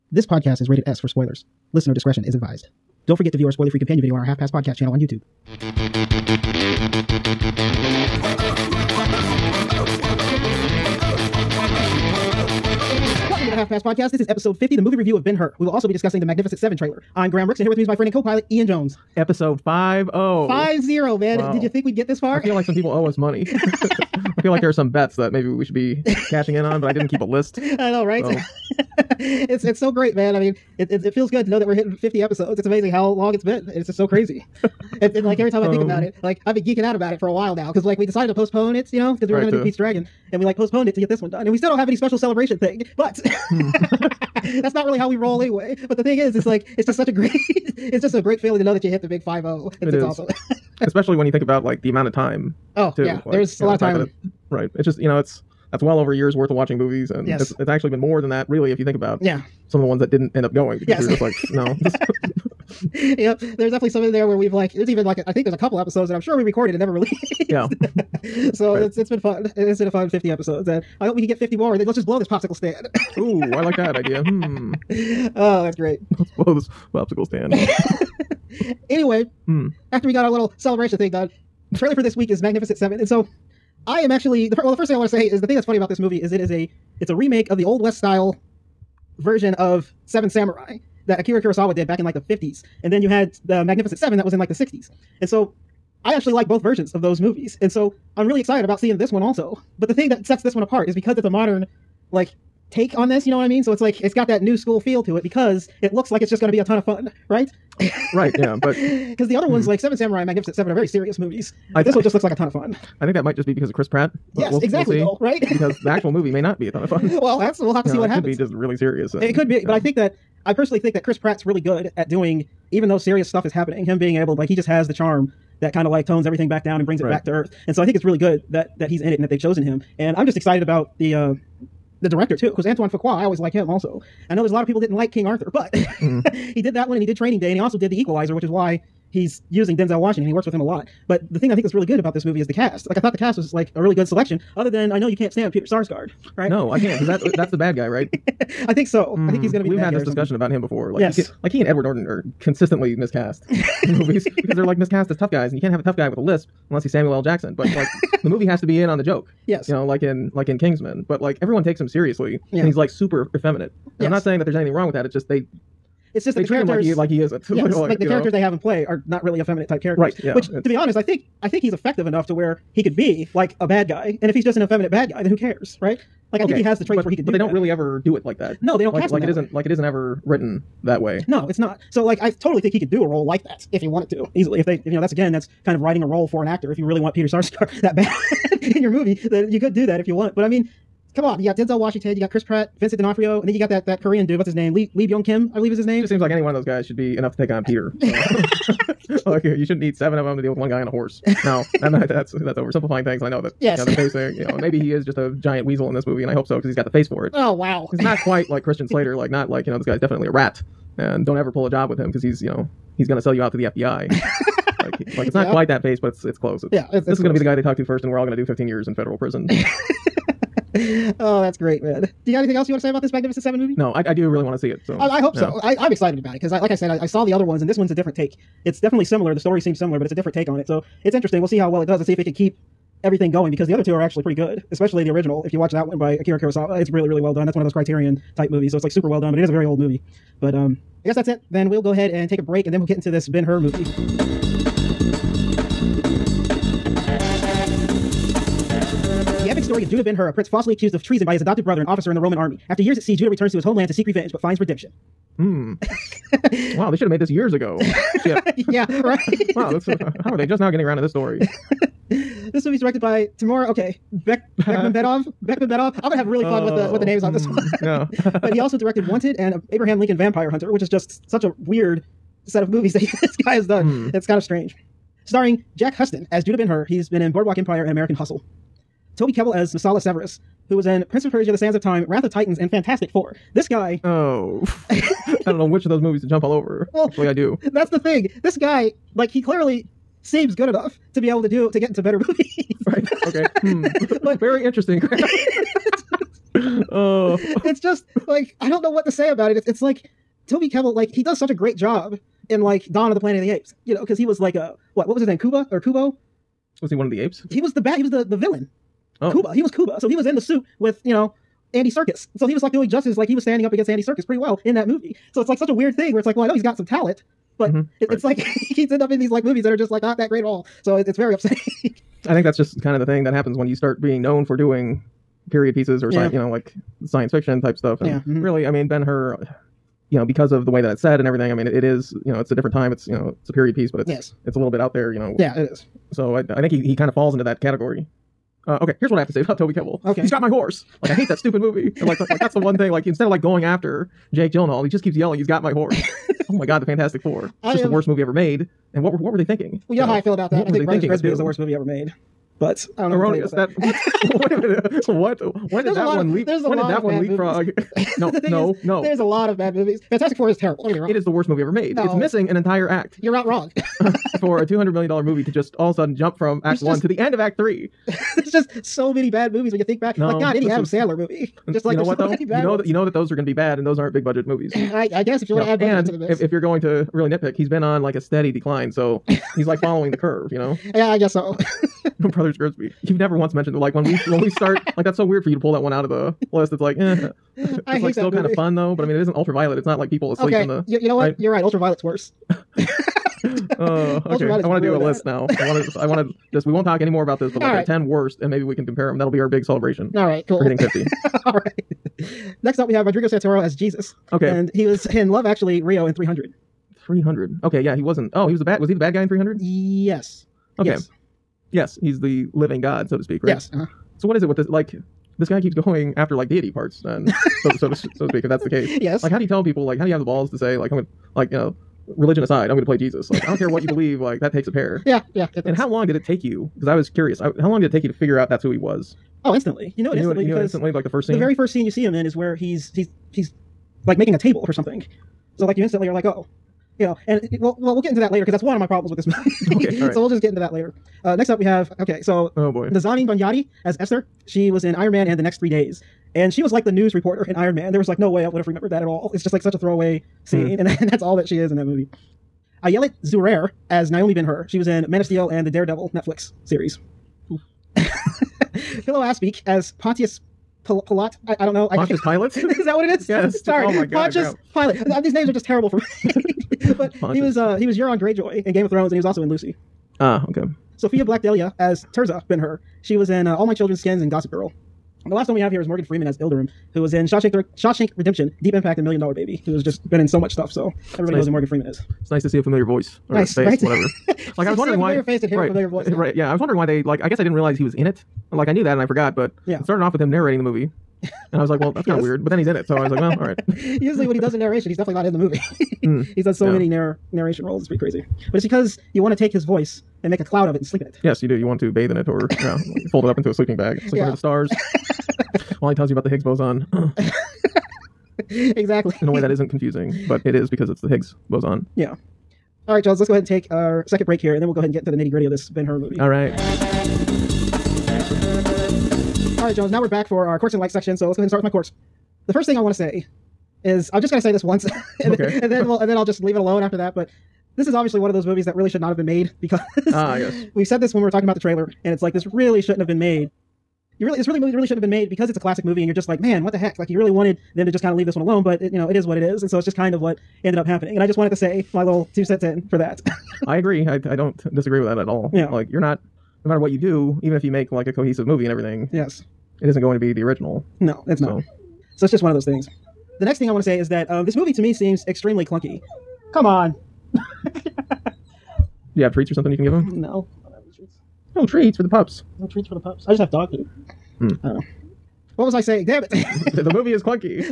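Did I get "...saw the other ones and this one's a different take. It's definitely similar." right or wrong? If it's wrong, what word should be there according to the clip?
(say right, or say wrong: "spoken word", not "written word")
right.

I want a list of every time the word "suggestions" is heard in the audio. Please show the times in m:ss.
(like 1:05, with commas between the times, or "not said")
not said.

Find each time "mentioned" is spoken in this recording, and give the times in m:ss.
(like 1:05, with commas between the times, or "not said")
6:23.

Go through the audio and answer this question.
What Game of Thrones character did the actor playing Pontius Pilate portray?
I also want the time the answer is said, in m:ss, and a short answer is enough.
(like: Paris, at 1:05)
Euron Greyjoy, at 7:47.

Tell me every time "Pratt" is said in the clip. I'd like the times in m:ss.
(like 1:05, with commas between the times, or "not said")
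1:53, 2:01, 3:12.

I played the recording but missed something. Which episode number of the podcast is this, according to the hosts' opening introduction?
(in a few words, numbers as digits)
50.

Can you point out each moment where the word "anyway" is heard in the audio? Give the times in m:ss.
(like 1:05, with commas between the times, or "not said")
0:45, 1:18.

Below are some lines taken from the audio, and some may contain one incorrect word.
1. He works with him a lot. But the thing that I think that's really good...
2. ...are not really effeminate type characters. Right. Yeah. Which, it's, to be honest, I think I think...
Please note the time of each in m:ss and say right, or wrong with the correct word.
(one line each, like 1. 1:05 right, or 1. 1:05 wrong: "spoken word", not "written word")
1. 2:20 right
2. 2:48 right.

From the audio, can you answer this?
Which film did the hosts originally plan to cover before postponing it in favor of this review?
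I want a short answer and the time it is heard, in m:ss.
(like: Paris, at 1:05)
Pete's Dragon, at 0:39.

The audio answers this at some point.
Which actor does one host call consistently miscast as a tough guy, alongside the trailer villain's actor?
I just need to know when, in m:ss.
2:31.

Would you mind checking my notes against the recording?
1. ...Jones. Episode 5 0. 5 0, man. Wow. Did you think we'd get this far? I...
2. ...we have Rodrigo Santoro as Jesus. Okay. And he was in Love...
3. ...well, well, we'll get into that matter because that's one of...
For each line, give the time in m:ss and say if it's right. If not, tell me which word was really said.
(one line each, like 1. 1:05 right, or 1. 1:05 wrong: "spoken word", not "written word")
1. 0:18 right
2. 6:42 right
3. 7:17 wrong: "later", not "matter".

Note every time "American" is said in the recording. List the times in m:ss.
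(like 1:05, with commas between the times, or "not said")
4:37.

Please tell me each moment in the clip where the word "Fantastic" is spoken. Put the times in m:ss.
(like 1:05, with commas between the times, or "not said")
4:42, 5:46, 6:00.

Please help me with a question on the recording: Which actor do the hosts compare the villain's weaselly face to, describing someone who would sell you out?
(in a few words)
Christian Slater.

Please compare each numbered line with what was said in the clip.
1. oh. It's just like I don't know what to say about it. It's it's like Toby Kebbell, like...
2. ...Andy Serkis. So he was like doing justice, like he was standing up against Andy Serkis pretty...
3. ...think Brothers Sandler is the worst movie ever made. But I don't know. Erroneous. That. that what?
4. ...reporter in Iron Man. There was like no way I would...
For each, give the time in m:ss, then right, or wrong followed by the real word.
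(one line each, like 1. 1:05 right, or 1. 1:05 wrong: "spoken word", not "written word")
1. 4:56 right
2. 5:11 right
3. 5:50 wrong: "Grimsby", not "Sandler"
4. 7:27 right.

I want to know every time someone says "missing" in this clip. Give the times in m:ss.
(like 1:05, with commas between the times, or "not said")
6:02.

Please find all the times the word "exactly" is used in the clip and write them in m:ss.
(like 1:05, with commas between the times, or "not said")
1:54, 8:28.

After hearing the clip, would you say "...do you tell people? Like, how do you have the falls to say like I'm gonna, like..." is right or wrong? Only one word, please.
wrong.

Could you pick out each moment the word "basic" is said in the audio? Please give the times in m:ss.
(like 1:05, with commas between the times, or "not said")
3:23.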